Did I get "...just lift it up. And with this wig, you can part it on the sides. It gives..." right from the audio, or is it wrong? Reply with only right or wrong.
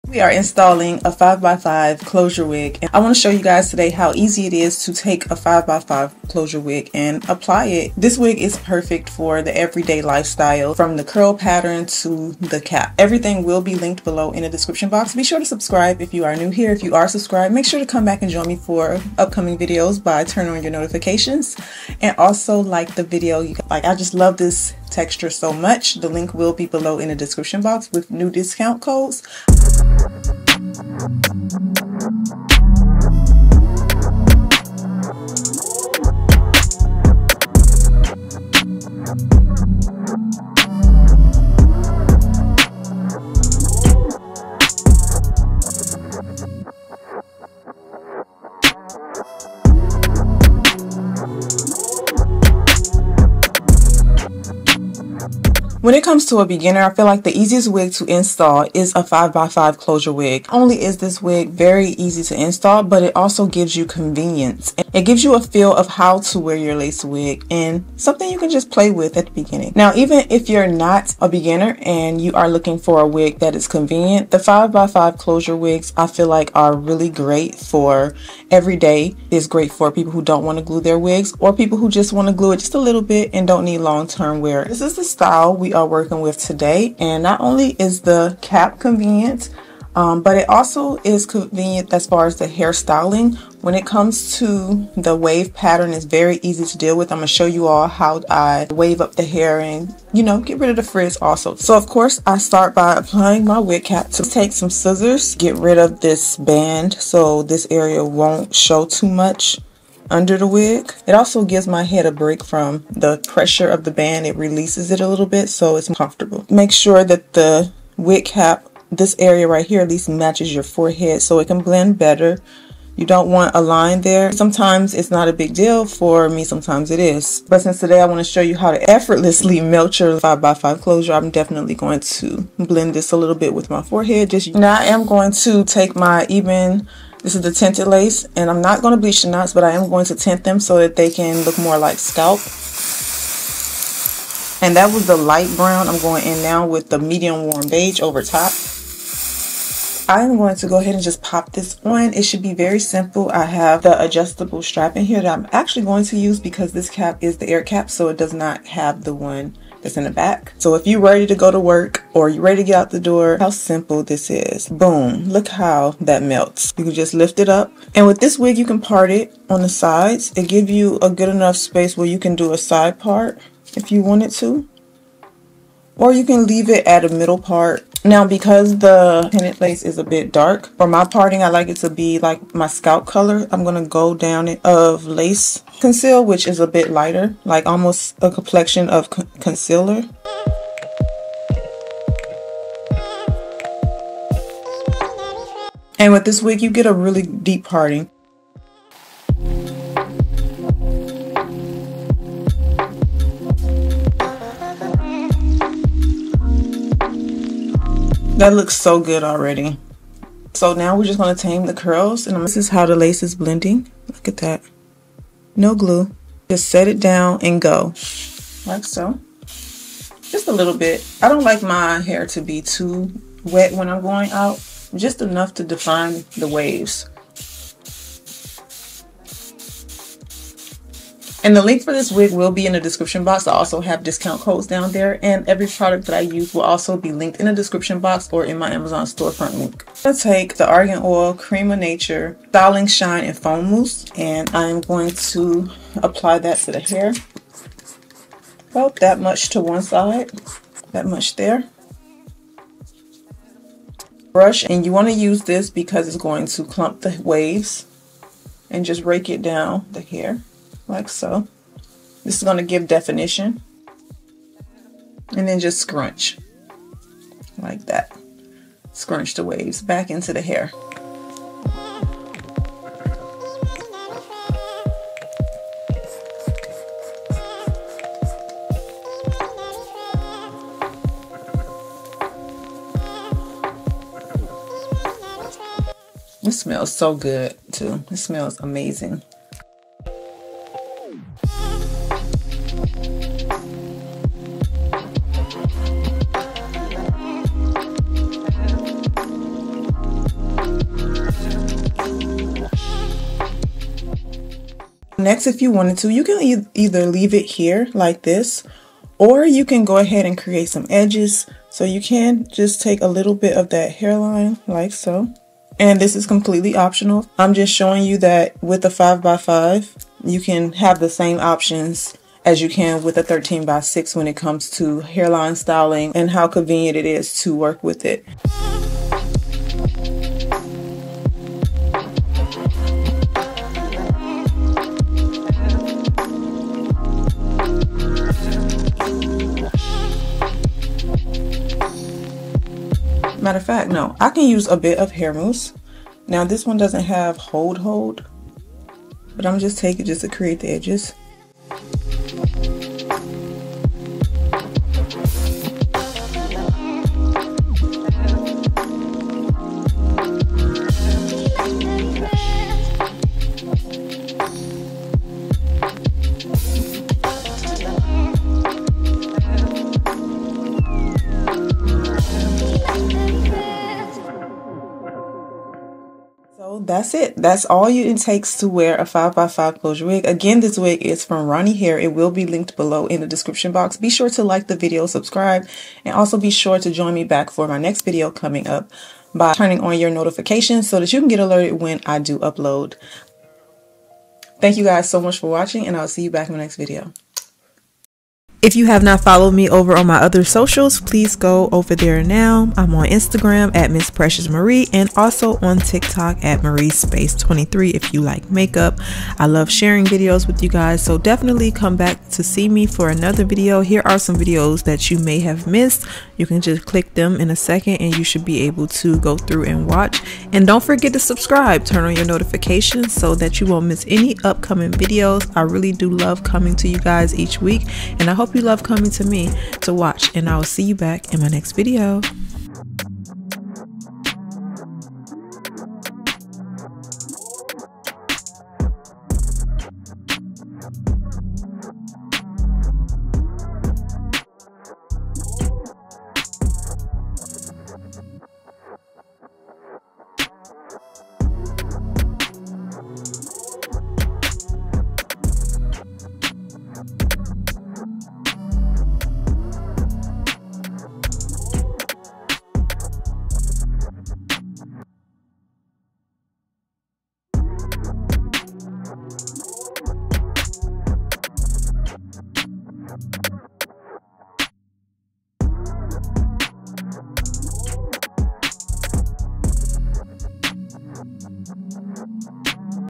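right.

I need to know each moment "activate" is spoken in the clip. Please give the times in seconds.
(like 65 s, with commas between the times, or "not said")
not said.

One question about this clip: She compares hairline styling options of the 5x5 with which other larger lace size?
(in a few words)
13x6.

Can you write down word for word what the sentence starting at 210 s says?
So now we're just going to tame the curls.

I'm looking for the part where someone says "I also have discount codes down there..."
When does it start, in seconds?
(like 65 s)
233 s.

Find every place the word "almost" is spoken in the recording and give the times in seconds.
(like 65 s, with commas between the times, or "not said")
187 s.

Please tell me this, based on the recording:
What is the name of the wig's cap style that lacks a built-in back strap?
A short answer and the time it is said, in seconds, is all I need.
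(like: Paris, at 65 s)
air cap, at 157 s.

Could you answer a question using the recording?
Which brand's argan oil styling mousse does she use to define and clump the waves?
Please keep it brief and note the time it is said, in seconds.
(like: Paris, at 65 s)
Cream of Nature, at 241 s.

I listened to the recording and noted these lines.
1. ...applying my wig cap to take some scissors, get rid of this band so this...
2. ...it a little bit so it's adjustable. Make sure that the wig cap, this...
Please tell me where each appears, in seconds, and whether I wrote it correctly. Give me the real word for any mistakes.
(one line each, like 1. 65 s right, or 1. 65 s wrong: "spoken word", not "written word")
1. 102 s right
2. 114 s wrong: "comfortable", not "adjustable".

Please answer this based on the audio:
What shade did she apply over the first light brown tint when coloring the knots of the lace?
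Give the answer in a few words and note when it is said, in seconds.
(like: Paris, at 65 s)
medium warm beige, at 146 s.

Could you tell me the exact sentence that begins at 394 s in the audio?
Thank you guys so much for watching, and I'll see you back in the next video.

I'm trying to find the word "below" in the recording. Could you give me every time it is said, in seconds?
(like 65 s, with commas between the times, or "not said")
14 s, 26 s, 382 s.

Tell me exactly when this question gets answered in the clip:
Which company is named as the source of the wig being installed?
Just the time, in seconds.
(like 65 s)
381 s.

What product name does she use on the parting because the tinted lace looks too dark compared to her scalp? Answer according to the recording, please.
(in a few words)
lace conceal.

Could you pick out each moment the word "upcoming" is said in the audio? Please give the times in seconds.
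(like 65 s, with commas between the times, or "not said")
19 s, 424 s.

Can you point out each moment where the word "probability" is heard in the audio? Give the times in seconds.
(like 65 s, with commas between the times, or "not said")
not said.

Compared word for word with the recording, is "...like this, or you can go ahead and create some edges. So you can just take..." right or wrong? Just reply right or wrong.
right.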